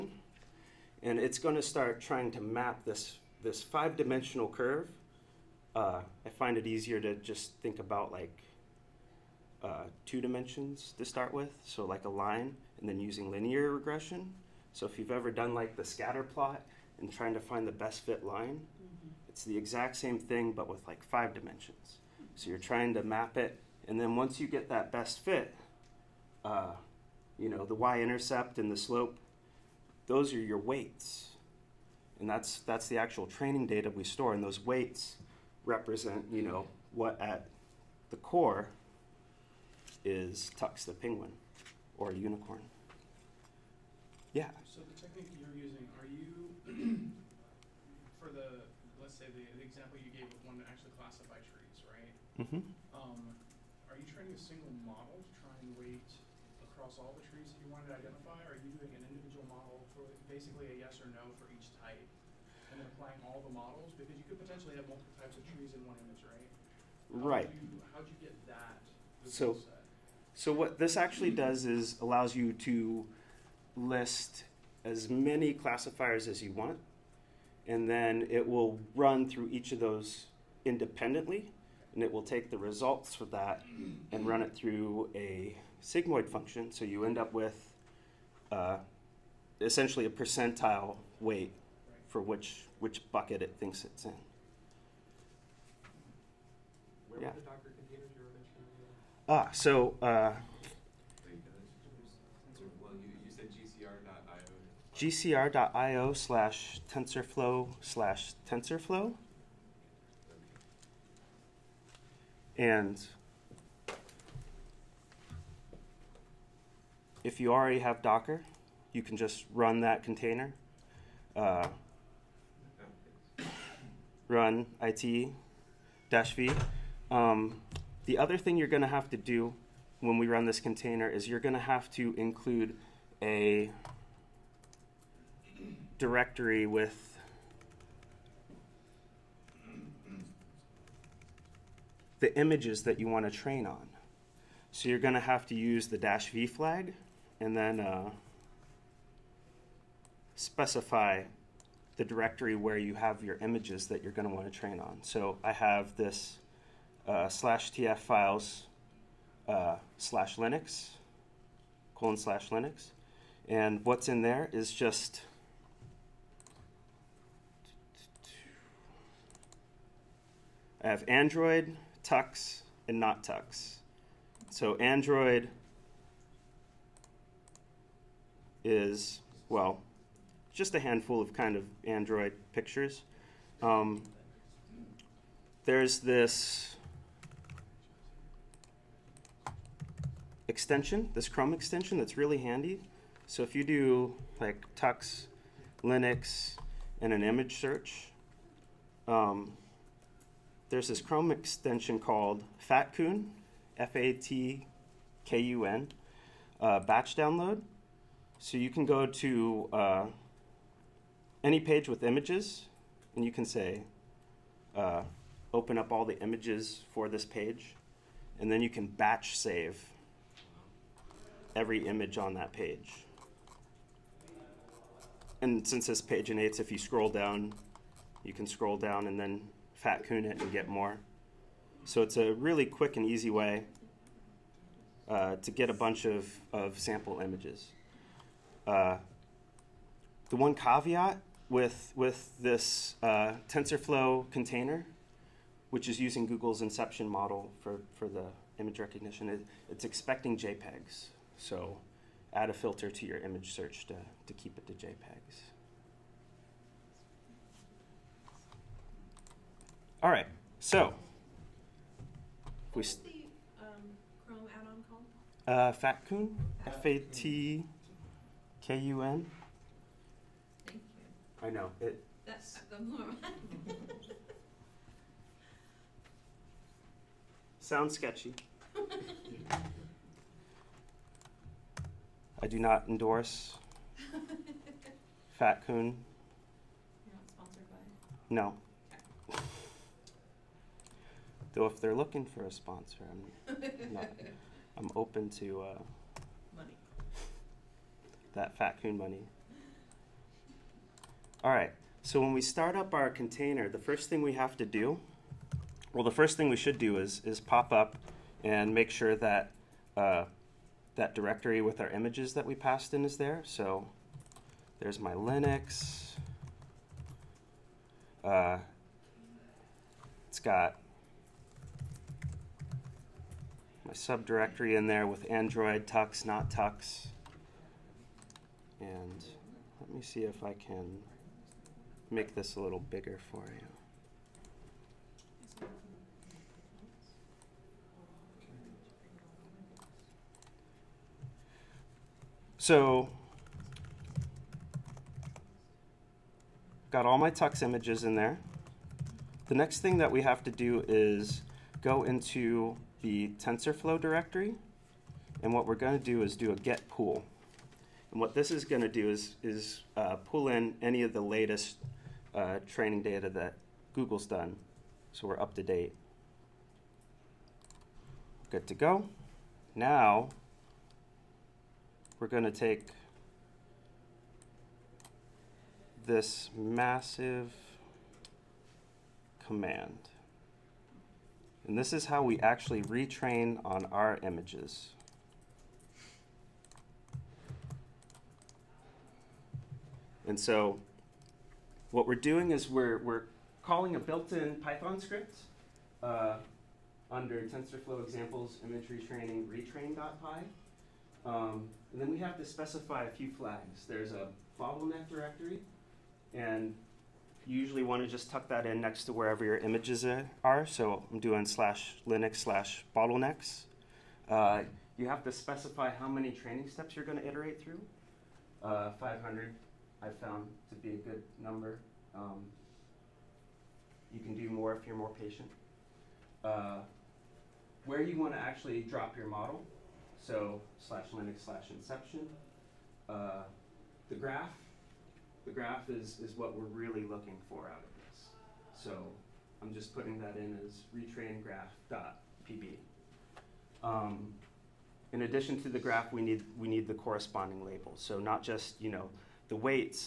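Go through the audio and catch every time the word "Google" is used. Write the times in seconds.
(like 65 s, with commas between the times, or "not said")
246 s, 363 s.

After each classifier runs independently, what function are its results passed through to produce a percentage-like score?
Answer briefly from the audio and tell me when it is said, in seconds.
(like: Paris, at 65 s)
sigmoid function, at 85 s.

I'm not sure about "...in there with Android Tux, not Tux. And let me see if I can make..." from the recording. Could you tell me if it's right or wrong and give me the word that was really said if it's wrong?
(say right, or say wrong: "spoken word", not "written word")
right.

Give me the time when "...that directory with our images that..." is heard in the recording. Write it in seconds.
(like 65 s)
310 s.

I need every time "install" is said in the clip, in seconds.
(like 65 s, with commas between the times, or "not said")
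not said.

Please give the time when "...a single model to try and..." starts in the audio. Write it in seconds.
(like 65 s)
54 s.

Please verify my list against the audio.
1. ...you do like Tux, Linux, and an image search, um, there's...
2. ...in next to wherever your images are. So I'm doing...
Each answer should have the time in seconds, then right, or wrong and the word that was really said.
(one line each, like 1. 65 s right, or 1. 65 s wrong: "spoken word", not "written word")
1. 193 s right
2. 408 s right.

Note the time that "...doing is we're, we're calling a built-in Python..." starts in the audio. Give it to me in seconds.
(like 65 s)
392 s.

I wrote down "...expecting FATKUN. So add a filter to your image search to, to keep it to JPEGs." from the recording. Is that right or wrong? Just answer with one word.
wrong.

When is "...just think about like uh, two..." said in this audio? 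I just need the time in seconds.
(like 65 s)
7 s.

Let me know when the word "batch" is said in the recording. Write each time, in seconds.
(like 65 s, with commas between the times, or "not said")
206 s, 218 s.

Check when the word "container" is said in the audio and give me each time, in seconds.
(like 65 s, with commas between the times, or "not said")
120 s, 130 s, 244 s, 303 s.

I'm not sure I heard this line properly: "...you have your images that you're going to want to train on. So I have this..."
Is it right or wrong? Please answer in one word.
right.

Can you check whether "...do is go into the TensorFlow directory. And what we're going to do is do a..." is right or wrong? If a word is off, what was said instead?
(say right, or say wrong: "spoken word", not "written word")
right.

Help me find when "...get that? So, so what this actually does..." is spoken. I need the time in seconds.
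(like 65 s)
68 s.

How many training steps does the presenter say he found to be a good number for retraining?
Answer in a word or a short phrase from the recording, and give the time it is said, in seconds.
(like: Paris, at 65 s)
500, at 418 s.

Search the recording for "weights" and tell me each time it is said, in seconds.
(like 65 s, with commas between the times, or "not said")
30 s, 34 s, 55 s, 91 s, 449 s.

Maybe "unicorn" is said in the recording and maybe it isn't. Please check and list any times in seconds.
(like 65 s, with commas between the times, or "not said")
42 s.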